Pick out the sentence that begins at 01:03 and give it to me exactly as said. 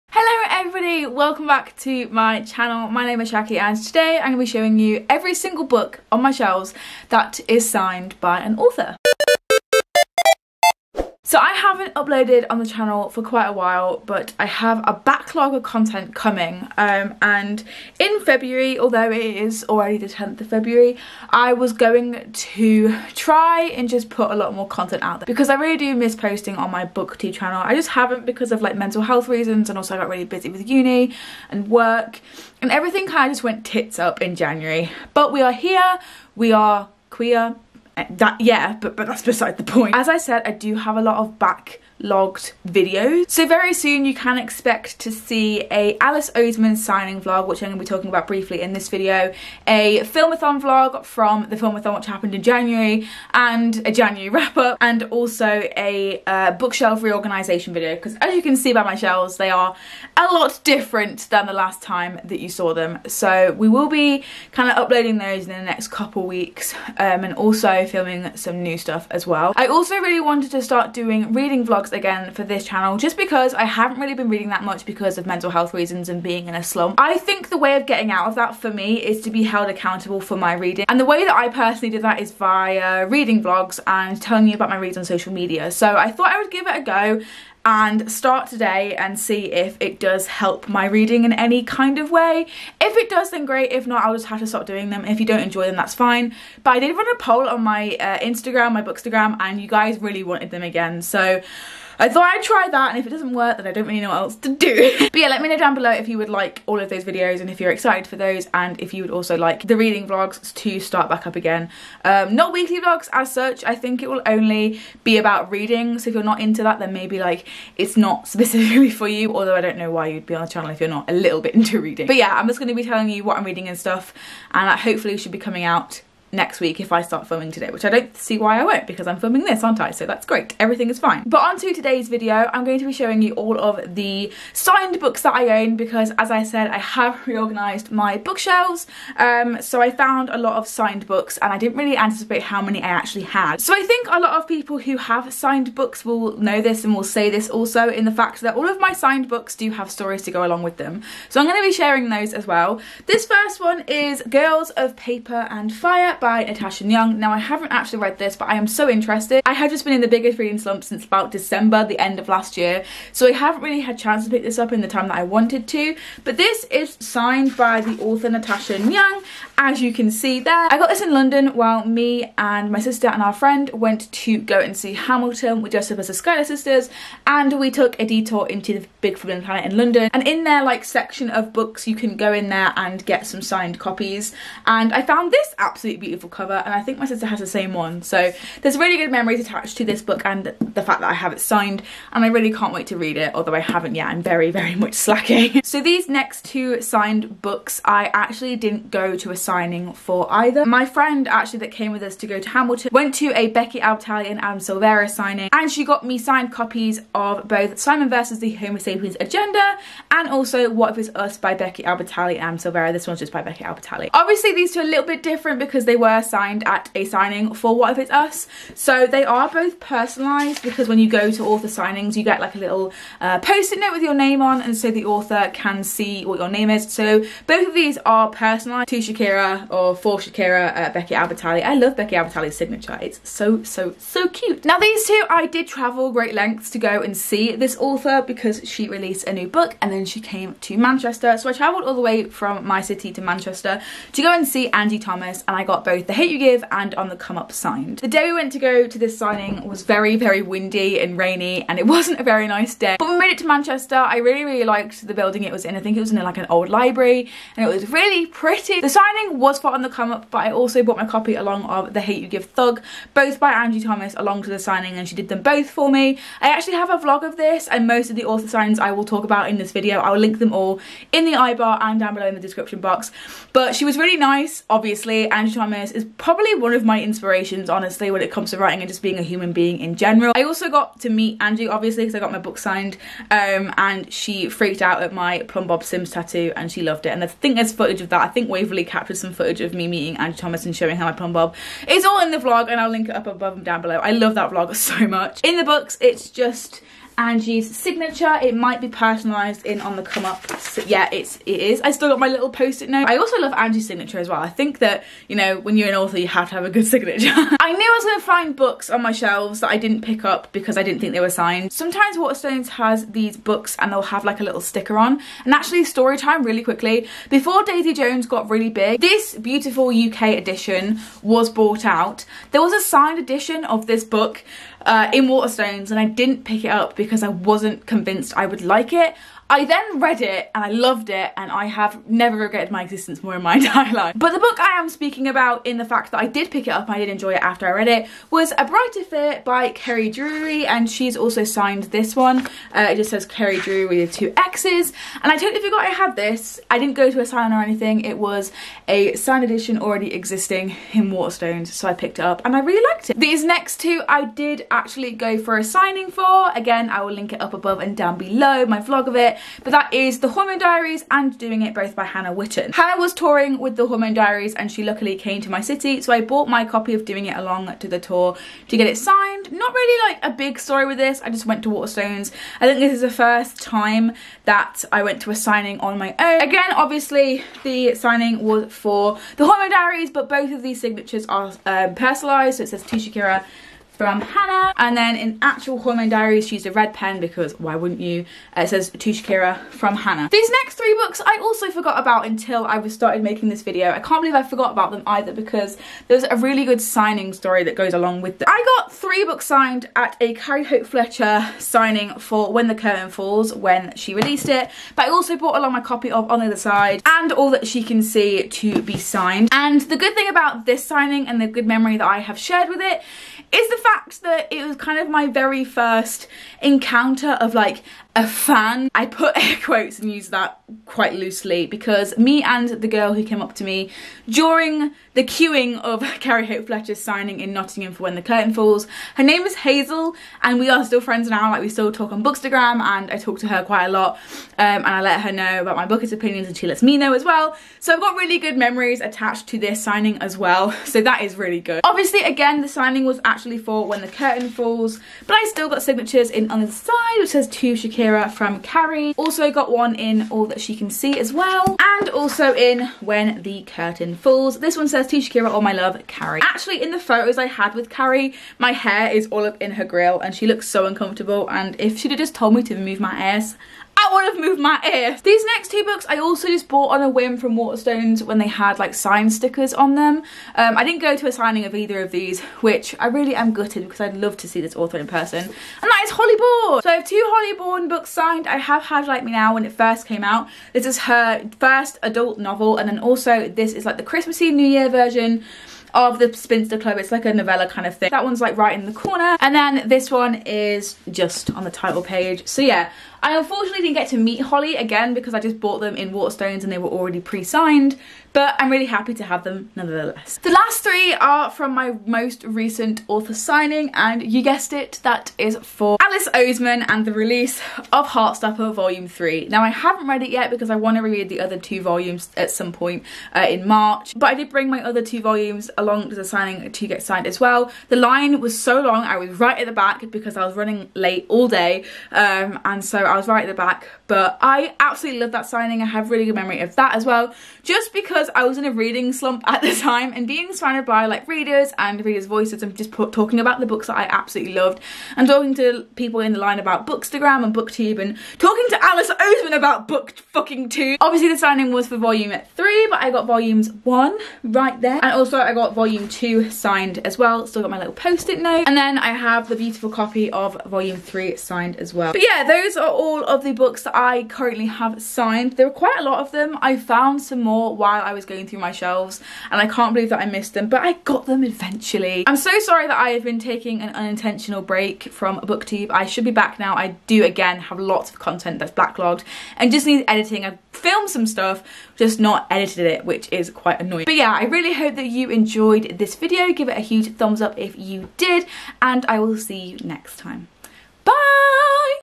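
So we will be kind of uploading those in the next couple weeks, um, and also filming some new stuff as well.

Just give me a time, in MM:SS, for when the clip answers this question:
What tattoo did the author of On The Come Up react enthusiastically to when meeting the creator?
04:45.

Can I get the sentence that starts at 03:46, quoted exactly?
So both of these are personalised to Shakira or for Shakira, uh, Becky Albertalli, I love Becky Albertalli's signature.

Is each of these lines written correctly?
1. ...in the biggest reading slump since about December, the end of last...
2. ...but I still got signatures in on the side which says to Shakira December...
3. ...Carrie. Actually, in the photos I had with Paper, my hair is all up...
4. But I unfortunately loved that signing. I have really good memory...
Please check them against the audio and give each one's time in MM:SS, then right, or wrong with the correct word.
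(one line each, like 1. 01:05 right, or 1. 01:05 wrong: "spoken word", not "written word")
1. 02:39 right
2. 07:25 wrong: "Kira", not "December"
3. 07:36 wrong: "Carrie", not "Paper"
4. 08:44 wrong: "absolutely", not "unfortunately".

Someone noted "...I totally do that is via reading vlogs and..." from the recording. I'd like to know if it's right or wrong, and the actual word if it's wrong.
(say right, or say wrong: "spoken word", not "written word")
wrong: "personally", not "totally".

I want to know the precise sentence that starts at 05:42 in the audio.
Uh, it just says Kerry Drewery with two X's and I totally forgot I had this.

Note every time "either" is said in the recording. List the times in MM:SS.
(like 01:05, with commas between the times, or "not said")
03:20, 06:35, 07:51.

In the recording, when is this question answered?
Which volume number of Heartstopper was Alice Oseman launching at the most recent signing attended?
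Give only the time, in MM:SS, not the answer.
08:28.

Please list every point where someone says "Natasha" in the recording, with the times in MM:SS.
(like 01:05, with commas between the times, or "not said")
02:36, 02:48.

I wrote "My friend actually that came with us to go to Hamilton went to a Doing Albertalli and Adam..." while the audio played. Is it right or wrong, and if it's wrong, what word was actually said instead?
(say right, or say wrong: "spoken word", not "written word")
wrong: "Becky", not "Doing".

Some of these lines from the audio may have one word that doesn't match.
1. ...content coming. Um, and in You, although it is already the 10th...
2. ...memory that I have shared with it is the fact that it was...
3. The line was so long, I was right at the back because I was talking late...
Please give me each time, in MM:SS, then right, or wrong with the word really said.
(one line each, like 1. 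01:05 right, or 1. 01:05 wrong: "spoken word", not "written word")
1. 00:15 wrong: "February", not "You"
2. 06:51 right
3. 08:37 wrong: "running", not "talking".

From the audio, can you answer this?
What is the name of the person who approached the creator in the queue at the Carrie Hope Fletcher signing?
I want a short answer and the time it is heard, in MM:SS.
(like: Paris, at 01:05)
Hazel, at 07:09.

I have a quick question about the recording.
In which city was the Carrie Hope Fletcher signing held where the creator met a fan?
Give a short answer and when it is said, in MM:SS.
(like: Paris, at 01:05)
Nottingham, at 07:07.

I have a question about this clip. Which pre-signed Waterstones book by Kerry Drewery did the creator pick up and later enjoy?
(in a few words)
A Brighter Fear.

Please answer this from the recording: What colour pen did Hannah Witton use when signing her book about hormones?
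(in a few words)
Red.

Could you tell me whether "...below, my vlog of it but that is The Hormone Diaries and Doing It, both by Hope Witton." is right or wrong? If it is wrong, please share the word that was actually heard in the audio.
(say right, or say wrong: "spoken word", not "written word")
wrong: "Hannah", not "Hope".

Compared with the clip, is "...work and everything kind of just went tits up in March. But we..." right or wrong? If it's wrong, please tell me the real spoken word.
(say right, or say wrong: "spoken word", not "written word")
wrong: "January", not "March".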